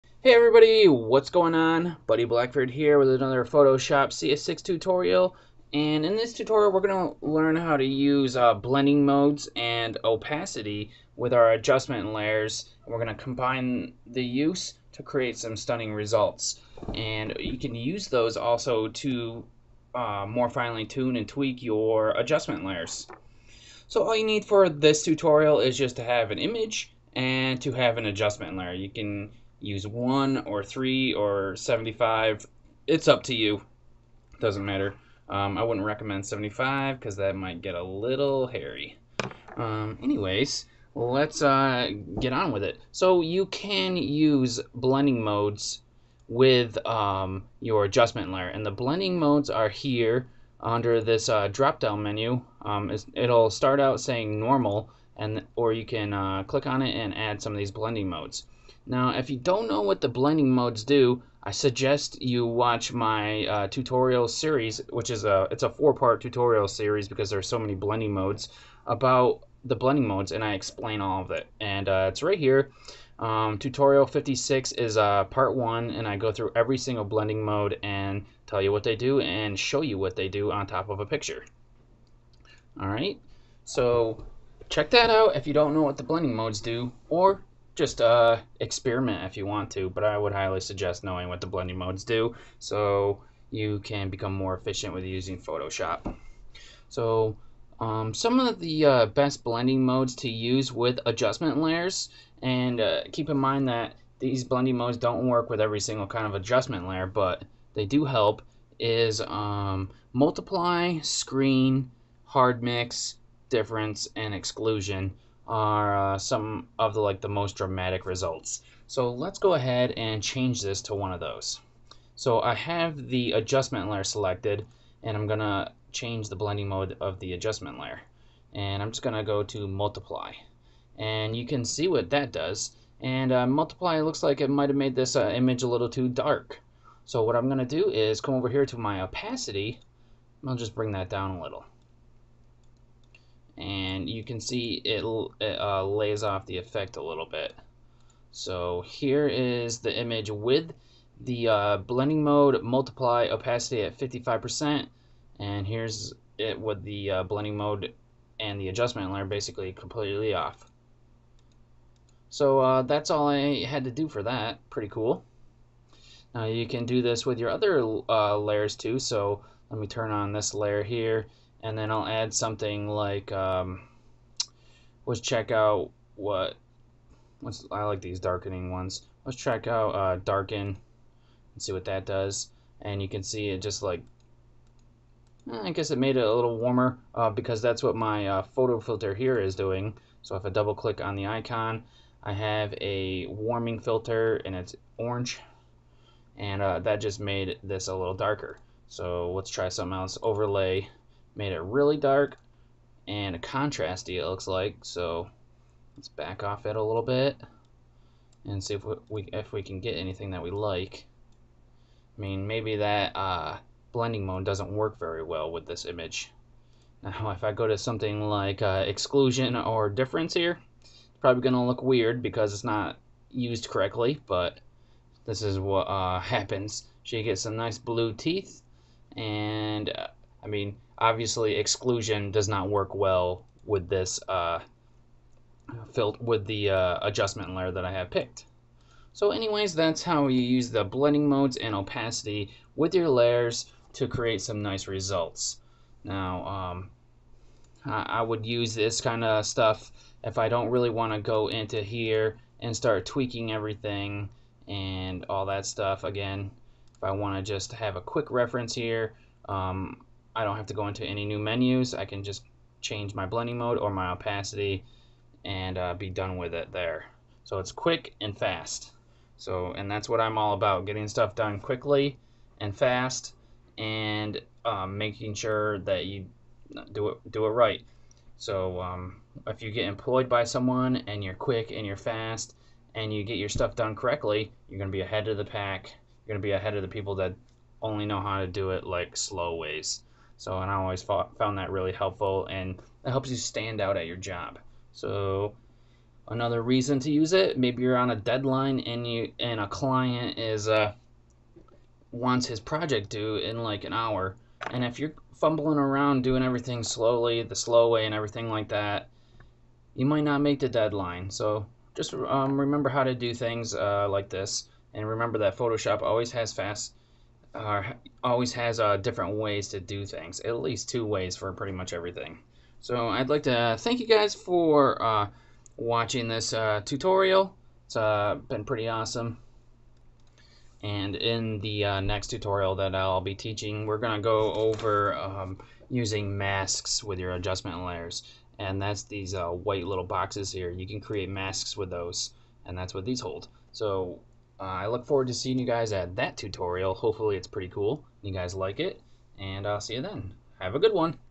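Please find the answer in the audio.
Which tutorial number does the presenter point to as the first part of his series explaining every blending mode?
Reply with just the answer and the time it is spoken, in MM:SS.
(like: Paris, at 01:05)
56, at 01:13.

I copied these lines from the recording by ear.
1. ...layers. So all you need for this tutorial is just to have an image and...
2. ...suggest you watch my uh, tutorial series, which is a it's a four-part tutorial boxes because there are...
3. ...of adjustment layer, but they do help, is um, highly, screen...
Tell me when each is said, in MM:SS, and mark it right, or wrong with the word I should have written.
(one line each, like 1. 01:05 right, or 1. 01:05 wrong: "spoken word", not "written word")
1. 00:22 right
2. 01:01 wrong: "series", not "boxes"
3. 01:46 wrong: "multiply", not "highly".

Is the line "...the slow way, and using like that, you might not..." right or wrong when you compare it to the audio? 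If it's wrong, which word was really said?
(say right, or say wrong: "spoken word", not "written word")
wrong: "everything", not "using".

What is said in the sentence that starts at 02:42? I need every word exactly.
So uh, that's all I had to do for that.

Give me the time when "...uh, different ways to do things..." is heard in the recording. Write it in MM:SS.
05:18.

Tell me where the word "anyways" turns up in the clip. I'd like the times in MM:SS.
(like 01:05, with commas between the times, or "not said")
00:40, 03:59.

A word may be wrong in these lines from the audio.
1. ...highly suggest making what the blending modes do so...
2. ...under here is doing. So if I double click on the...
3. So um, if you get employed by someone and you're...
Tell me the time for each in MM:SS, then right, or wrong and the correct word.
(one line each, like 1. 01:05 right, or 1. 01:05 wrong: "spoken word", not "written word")
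1. 01:30 wrong: "knowing", not "making"
2. 03:08 wrong: "filter", not "under"
3. 04:38 right.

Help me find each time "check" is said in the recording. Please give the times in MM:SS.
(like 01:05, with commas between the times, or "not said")
01:24, 02:55, 02:59.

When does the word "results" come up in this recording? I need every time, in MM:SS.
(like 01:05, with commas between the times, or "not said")
00:15, 01:58, 04:04.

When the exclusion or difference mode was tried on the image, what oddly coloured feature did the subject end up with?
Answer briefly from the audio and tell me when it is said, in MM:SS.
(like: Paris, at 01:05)
Blue teeth, at 03:47.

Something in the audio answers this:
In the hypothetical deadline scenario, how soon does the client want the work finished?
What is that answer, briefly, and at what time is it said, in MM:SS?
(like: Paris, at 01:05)
An hour, at 05:03.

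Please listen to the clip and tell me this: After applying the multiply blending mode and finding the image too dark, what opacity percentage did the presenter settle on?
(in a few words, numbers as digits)
55%.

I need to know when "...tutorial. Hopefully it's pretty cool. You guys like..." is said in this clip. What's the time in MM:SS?
05:46.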